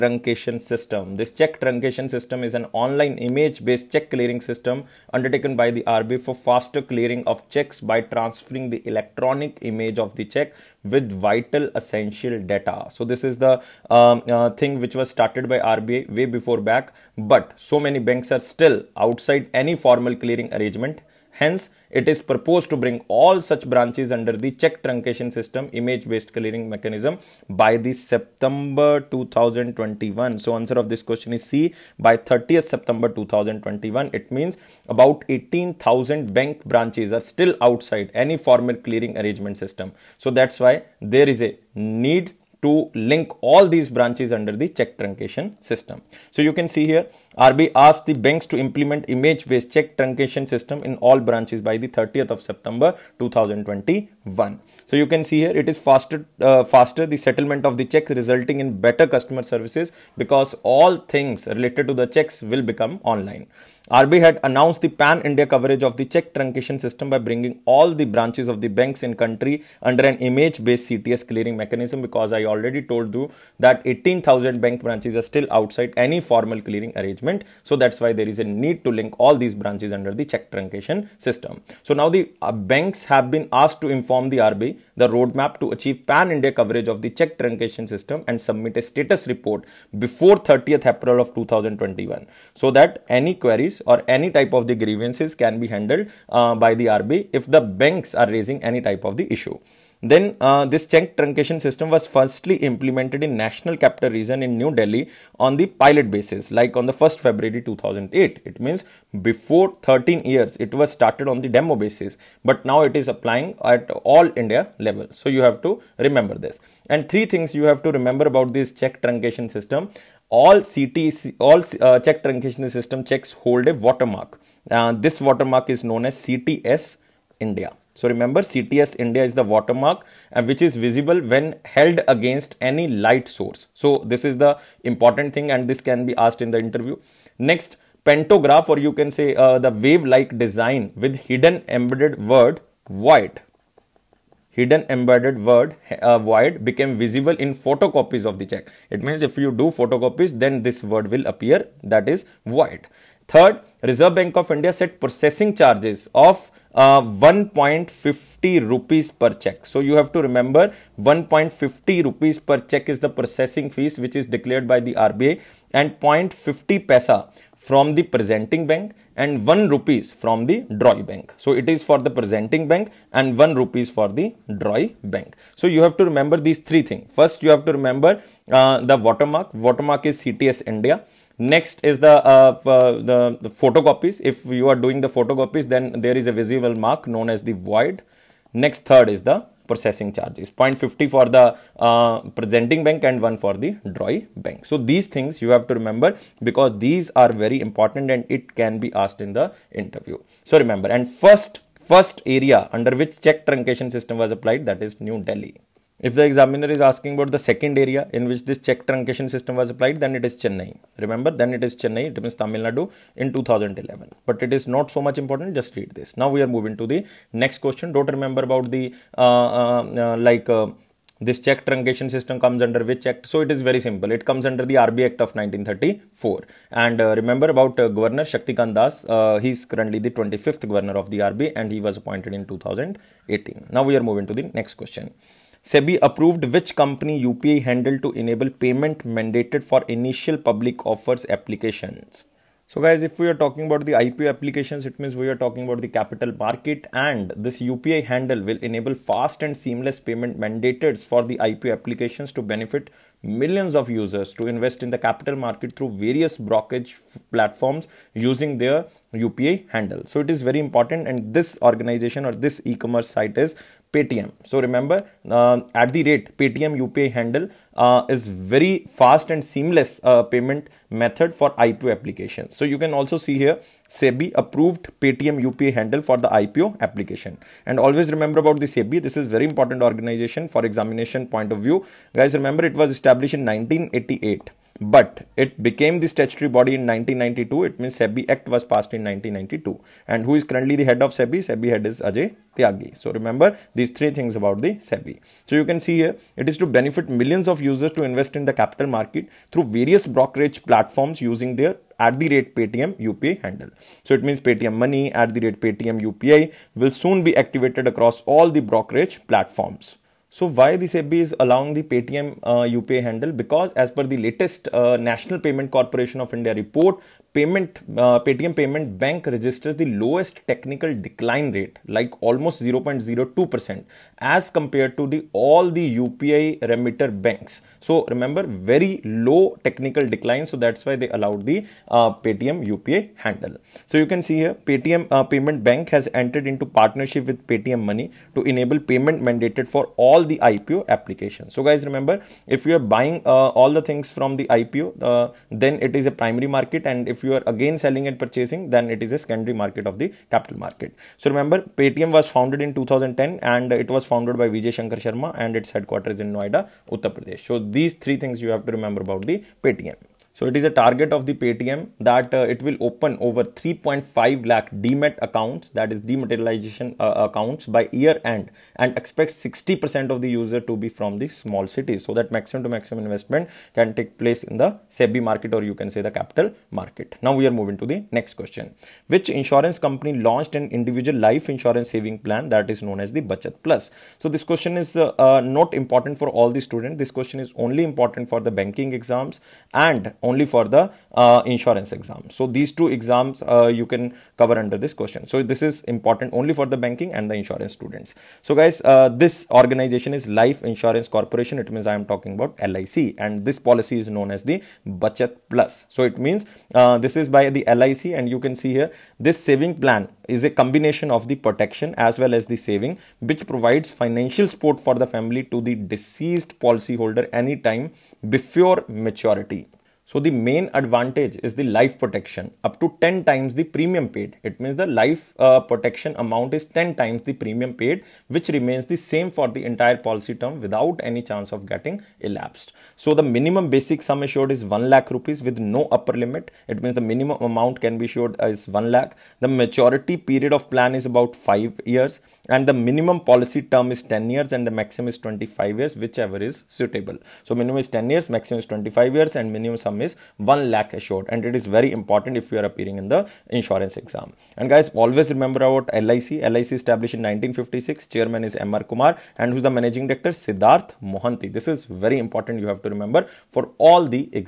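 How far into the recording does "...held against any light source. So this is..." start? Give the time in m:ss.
2:11.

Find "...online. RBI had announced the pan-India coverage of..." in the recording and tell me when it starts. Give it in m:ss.
1:03.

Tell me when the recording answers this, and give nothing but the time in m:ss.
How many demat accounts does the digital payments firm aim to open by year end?
6:03.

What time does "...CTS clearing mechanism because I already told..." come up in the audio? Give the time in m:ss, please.
1:10.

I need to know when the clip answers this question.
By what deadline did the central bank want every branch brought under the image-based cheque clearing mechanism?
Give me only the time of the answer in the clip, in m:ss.
0:51.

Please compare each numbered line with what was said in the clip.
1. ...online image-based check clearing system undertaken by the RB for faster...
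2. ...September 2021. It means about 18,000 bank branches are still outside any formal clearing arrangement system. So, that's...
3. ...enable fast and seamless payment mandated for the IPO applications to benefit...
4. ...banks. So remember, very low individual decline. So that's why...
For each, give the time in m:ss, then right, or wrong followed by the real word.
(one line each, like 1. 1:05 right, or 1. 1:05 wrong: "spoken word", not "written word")
1. 0:02 right
2. 0:32 right
3. 4:08 right
4. 5:27 wrong: "technical", not "individual".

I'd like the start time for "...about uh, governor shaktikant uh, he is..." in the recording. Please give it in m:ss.
3:47.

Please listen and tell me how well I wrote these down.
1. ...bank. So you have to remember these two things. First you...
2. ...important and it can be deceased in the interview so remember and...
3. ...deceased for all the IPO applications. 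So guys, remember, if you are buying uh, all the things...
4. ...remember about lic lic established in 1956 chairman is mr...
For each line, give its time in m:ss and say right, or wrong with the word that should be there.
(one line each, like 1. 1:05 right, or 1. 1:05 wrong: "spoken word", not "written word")
1. 2:55 wrong: "three", not "two"
2. 3:17 wrong: "asked", not "deceased"
3. 5:39 wrong: "mandated", not "deceased"
4. 7:35 right.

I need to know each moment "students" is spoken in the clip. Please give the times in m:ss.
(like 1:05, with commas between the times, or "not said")
6:26, 6:37.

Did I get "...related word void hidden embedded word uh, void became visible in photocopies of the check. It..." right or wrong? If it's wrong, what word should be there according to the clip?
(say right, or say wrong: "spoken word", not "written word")
wrong: "embedded", not "related".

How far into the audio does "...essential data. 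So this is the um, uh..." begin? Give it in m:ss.
0:11.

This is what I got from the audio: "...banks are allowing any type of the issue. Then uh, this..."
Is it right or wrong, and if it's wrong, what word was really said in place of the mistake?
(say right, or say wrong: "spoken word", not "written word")
wrong: "raising", not "allowing".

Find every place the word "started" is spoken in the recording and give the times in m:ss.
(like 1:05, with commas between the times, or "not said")
0:15, 1:50.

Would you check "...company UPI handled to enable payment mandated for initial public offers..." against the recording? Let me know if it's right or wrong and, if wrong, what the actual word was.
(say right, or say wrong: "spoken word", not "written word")
right.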